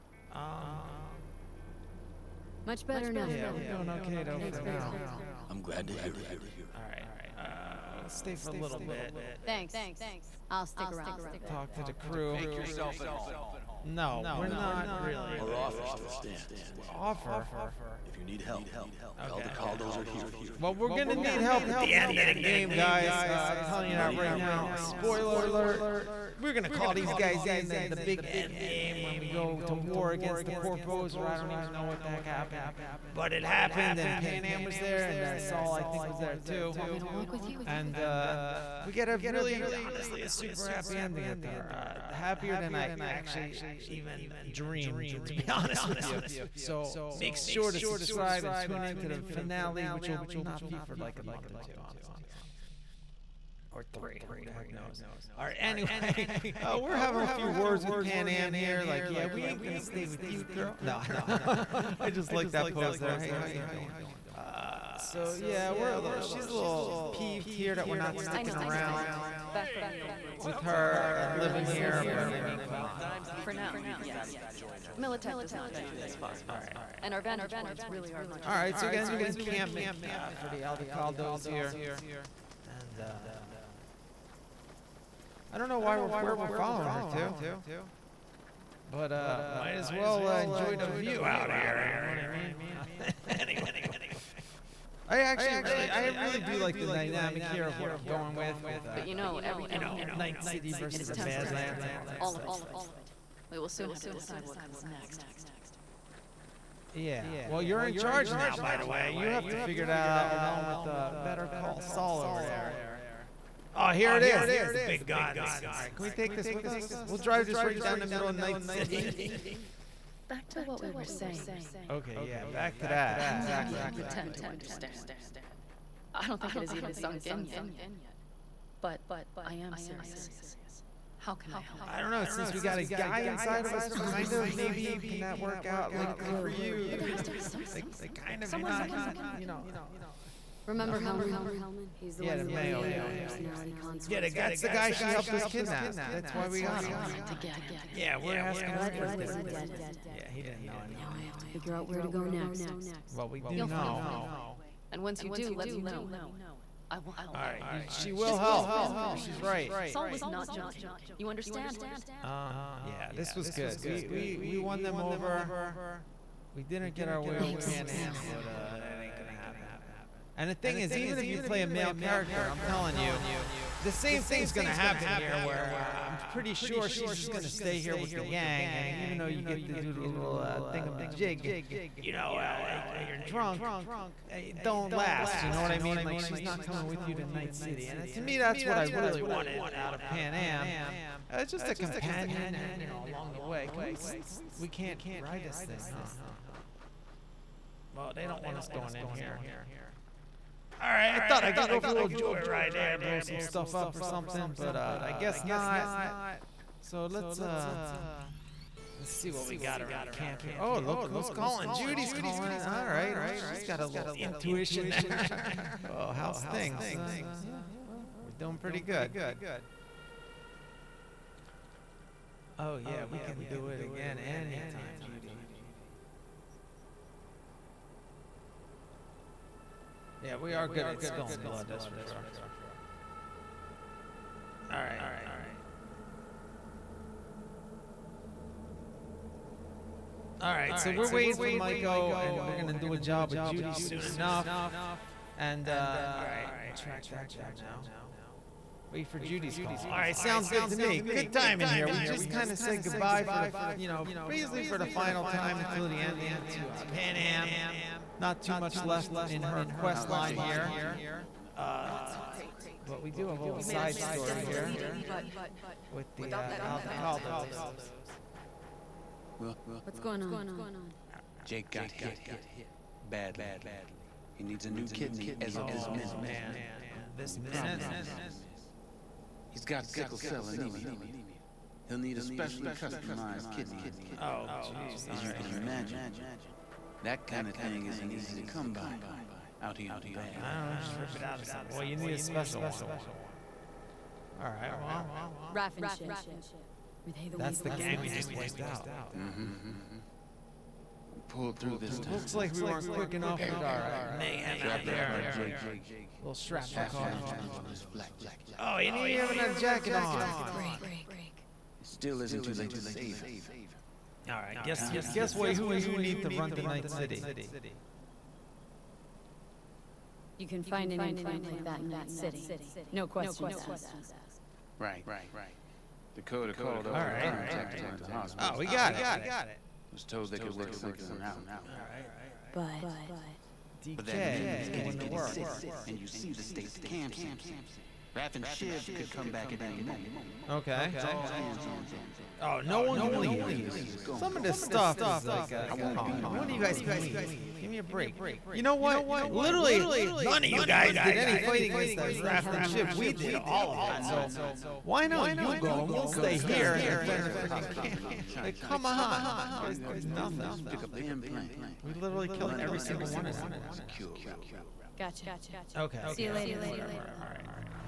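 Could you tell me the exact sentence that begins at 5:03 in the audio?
with our uh, mayhem Shrapnel out there.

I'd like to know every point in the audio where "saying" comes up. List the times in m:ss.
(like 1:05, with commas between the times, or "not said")
2:01.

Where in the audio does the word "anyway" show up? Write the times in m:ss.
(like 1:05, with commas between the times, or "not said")
0:55, 1:33.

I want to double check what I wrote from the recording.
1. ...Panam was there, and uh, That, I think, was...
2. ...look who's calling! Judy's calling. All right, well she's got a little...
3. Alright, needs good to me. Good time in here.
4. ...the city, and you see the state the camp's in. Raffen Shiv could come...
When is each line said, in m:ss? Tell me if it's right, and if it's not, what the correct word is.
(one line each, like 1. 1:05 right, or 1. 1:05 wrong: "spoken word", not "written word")
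1. 0:34 wrong: "Saul", not "That"
2. 3:30 right
3. 4:09 wrong: "sounds", not "needs"
4. 5:35 right.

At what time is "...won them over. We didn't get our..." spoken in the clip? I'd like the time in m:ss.
2:44.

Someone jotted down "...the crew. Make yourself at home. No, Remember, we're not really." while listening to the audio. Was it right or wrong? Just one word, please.
right.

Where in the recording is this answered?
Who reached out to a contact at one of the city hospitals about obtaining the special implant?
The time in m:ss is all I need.
5:26.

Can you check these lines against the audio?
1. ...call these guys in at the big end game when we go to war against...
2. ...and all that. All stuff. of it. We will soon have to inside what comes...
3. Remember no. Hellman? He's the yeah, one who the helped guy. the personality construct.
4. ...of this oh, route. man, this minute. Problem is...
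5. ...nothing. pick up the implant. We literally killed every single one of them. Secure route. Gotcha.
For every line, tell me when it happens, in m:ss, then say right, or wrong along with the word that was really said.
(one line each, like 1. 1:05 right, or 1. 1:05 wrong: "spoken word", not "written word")
1. 0:26 right
2. 1:41 wrong: "decide", not "inside"
3. 2:20 wrong: "created", not "helped"
4. 4:35 wrong: "minute", not "route"
5. 6:00 right.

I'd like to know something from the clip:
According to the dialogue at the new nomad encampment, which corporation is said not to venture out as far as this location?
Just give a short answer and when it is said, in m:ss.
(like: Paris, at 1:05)
Militech, at 1:14.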